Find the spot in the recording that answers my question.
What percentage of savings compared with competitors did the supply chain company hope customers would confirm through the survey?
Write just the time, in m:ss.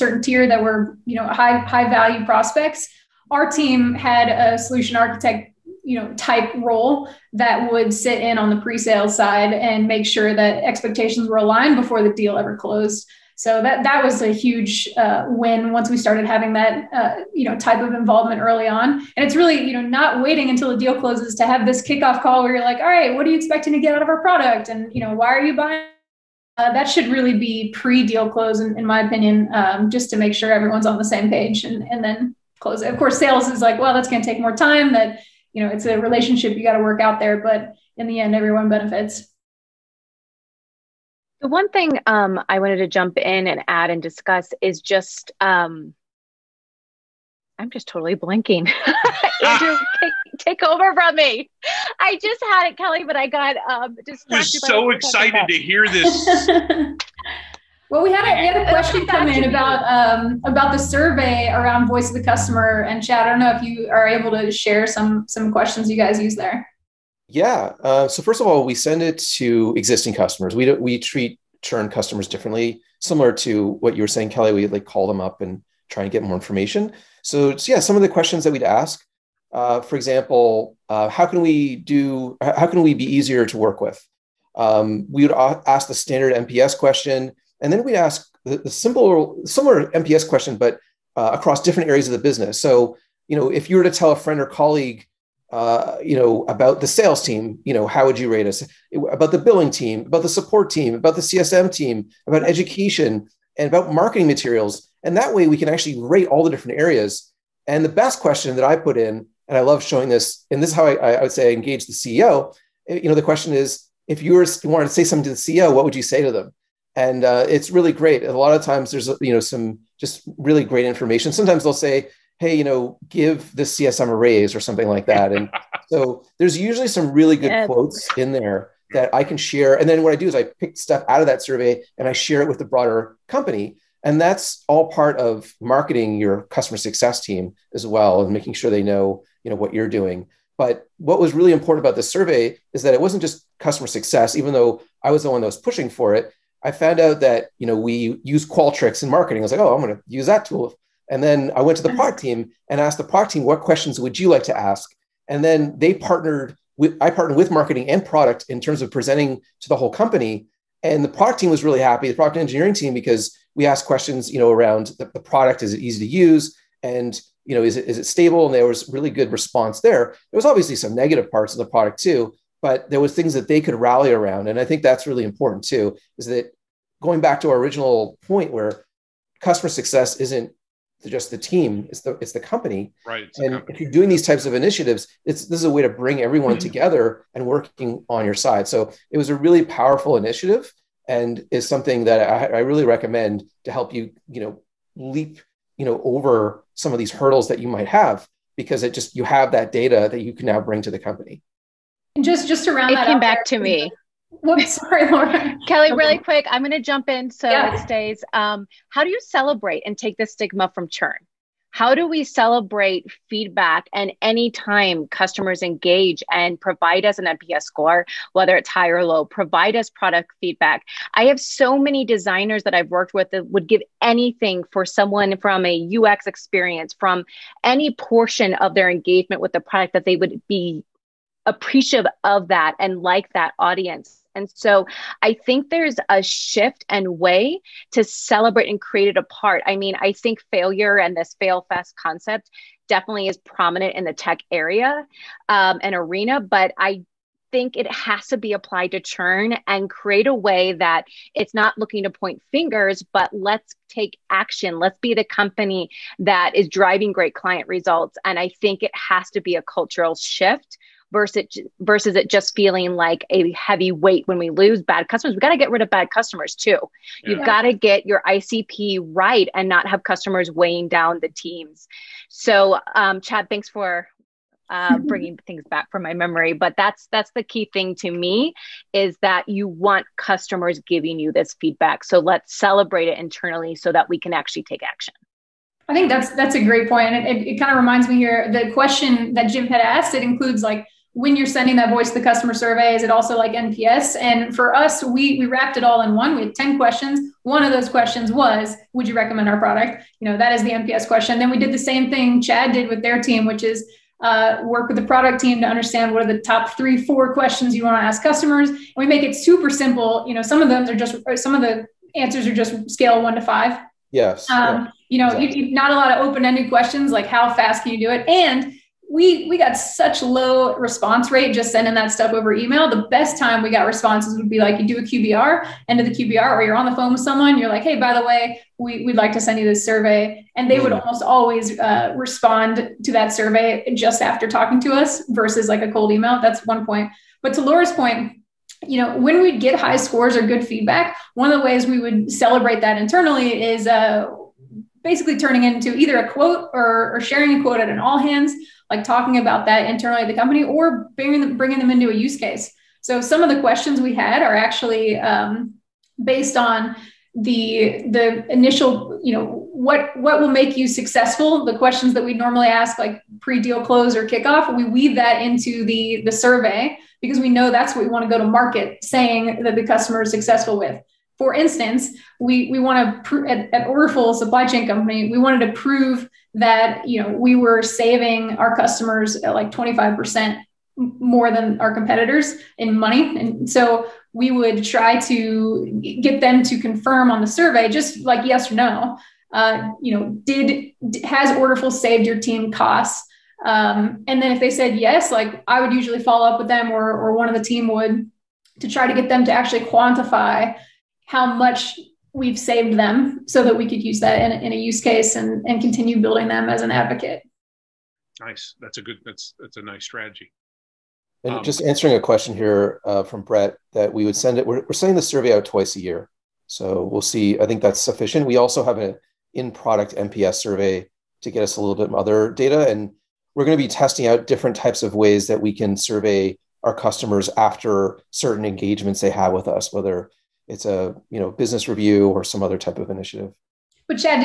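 6:19.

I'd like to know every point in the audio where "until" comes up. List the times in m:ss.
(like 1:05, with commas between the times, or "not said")
0:20.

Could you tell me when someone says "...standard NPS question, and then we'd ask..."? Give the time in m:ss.
1:25.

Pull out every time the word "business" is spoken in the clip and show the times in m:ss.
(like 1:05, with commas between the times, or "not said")
1:32, 7:11.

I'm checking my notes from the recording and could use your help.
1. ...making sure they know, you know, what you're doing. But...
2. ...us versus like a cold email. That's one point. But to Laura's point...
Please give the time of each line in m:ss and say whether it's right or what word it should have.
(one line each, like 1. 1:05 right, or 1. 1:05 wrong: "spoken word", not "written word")
1. 2:18 right
2. 5:34 right.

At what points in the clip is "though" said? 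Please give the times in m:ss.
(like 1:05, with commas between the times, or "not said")
2:24.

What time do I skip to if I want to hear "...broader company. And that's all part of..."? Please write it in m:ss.
2:12.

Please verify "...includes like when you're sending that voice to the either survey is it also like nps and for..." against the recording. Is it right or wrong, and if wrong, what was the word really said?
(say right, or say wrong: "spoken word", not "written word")
wrong: "customer", not "either".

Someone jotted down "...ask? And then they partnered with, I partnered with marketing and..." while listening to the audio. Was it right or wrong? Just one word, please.
right.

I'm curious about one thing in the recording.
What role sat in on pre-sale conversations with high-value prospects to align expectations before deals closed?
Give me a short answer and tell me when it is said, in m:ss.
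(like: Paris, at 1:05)
Solution architect, at 0:04.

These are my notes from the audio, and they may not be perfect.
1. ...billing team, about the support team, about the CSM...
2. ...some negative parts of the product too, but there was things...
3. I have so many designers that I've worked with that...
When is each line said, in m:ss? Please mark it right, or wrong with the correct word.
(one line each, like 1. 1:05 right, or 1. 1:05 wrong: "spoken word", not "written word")
1. 1:39 right
2. 2:50 right
3. 3:41 right.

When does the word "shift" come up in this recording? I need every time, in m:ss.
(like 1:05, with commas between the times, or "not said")
3:56, 4:20.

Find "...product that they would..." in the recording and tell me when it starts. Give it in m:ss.
3:49.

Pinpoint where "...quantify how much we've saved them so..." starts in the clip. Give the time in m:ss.
6:39.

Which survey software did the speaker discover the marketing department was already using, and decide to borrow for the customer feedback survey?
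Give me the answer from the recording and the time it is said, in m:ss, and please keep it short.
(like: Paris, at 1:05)
Qualtrics, at 2:28.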